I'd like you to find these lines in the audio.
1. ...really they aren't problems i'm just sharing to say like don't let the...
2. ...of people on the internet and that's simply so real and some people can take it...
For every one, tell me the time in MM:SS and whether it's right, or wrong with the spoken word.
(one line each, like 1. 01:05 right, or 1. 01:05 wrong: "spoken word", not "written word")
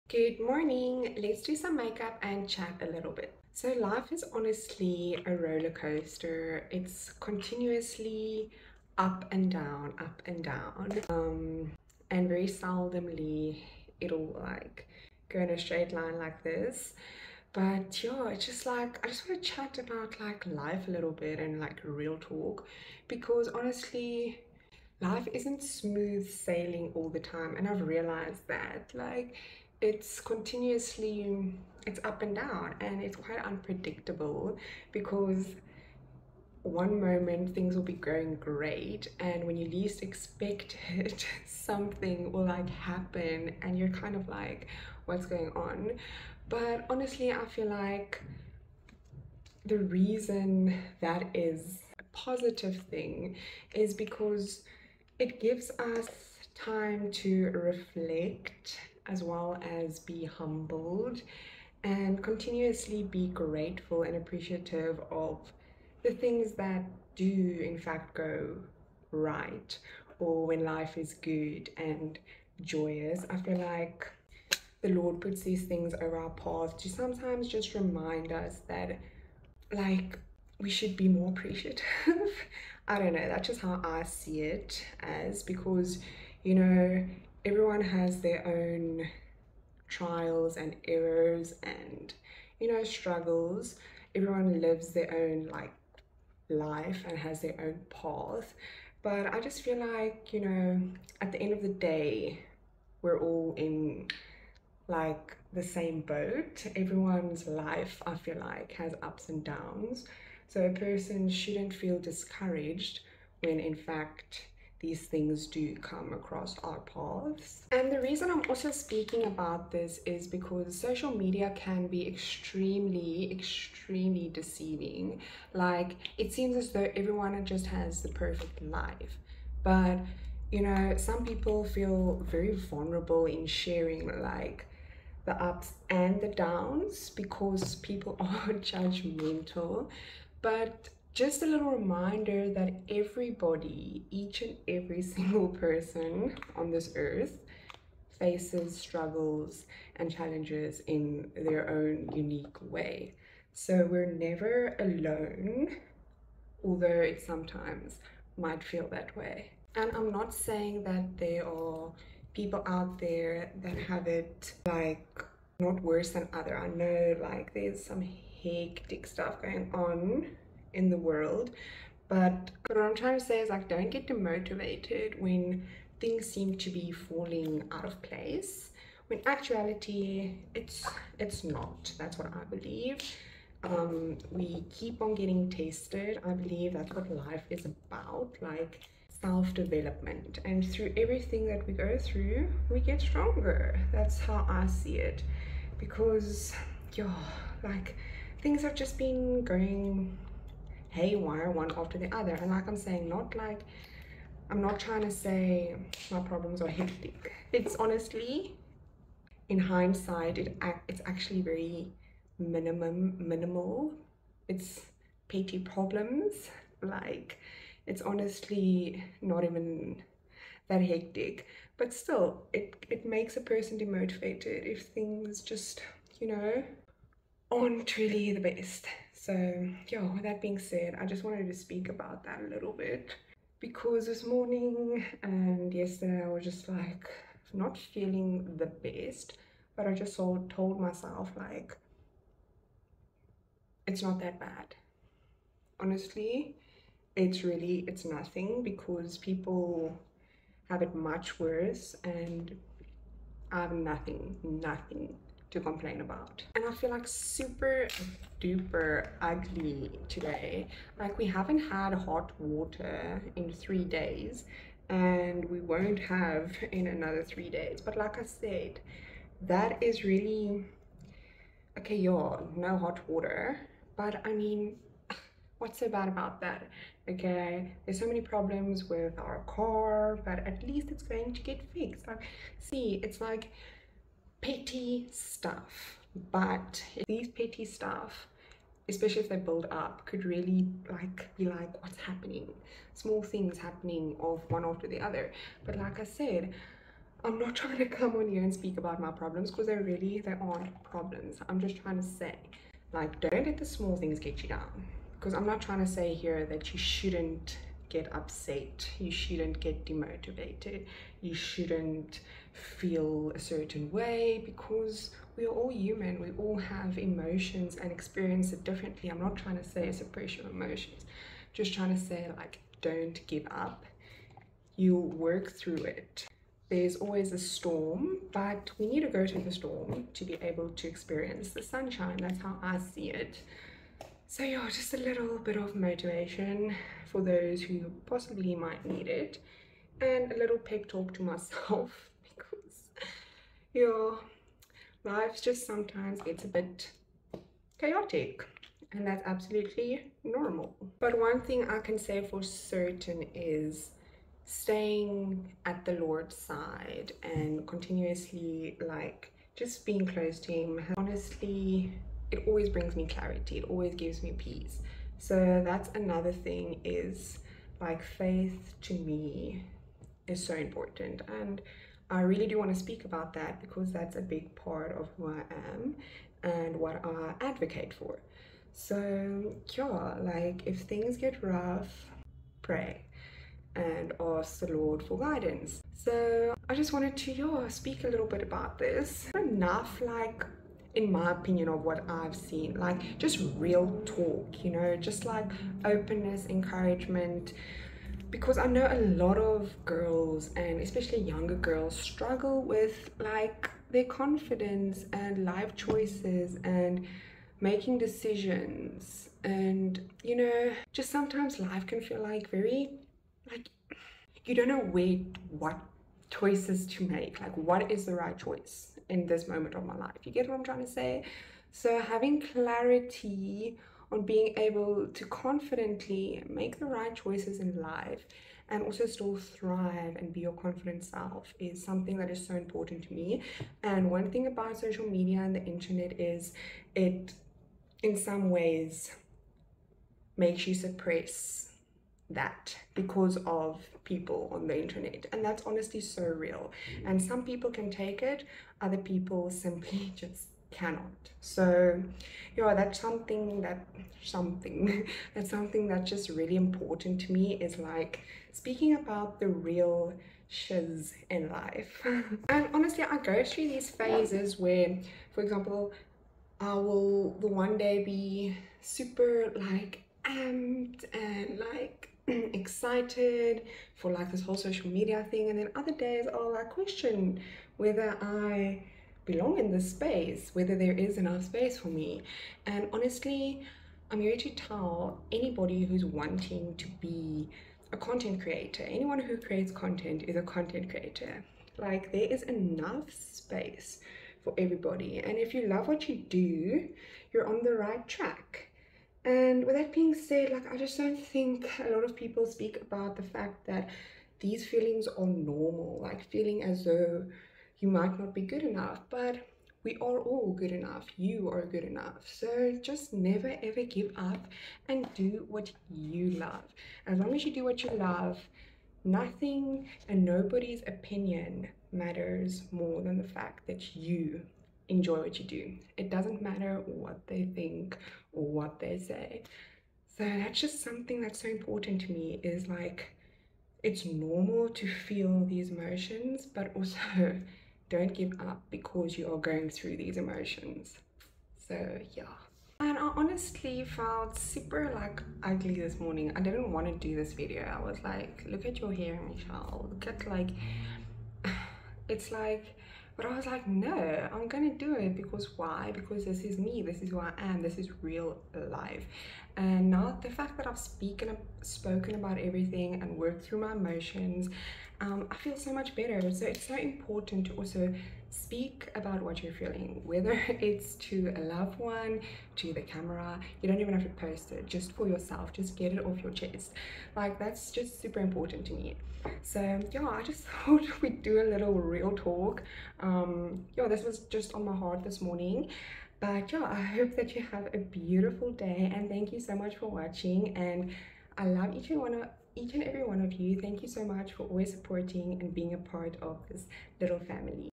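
1. 04:59 wrong: "trying", not "sharing"
2. 07:23 wrong: "honestly", not "simply".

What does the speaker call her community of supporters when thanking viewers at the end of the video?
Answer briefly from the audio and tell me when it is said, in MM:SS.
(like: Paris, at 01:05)
Little family, at 09:56.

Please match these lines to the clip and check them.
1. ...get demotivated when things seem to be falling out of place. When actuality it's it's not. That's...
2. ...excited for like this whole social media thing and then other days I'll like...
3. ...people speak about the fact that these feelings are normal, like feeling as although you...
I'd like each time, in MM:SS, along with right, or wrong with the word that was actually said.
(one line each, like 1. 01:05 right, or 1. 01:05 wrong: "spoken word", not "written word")
1. 02:53 right
2. 07:52 right
3. 08:22 wrong: "though", not "although".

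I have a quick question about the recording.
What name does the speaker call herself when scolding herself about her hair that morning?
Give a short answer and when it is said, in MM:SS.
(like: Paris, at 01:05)
Michelle, at 09:09.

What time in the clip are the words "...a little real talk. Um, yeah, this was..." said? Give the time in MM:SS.
09:41.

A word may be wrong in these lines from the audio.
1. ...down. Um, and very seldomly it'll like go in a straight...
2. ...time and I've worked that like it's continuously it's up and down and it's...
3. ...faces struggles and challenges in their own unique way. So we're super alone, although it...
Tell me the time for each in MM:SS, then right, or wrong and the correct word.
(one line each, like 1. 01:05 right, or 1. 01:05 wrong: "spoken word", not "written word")
1. 00:10 right
2. 00:27 wrong: "realized", not "worked"
3. 02:28 wrong: "never", not "super".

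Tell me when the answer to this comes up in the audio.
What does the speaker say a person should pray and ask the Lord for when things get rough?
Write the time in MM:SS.
06:25.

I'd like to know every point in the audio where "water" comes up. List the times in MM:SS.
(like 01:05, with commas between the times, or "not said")
04:22, 04:33.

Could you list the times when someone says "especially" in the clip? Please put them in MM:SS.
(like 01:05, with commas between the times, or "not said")
04:48, 06:40.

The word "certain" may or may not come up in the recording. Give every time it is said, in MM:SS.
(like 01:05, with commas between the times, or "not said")
05:13, 05:52.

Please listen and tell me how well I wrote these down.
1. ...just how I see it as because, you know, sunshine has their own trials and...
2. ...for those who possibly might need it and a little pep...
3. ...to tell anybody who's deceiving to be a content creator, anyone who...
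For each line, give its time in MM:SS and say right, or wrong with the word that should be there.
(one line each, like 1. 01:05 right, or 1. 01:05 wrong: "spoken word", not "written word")
1. 01:23 wrong: "everyone", not "sunshine"
2. 05:37 right
3. 08:04 wrong: "wanting", not "deceiving".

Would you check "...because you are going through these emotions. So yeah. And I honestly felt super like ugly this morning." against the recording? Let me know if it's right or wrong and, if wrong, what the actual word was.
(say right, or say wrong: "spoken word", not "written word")
right.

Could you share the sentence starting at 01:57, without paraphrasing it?
And the reason I'm also speaking about this is because social media can be extremely, extremely deceiving.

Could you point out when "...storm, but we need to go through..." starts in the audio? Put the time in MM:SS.
05:27.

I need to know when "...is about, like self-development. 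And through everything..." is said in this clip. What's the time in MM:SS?
03:07.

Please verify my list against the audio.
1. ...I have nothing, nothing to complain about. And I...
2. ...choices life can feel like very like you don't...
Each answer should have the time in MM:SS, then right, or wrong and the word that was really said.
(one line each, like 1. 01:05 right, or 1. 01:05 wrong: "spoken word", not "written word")
1. 04:13 right
2. 06:51 wrong: "sometimes", not "choices".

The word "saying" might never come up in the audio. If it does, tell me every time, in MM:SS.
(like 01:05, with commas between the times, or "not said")
02:40, 03:22.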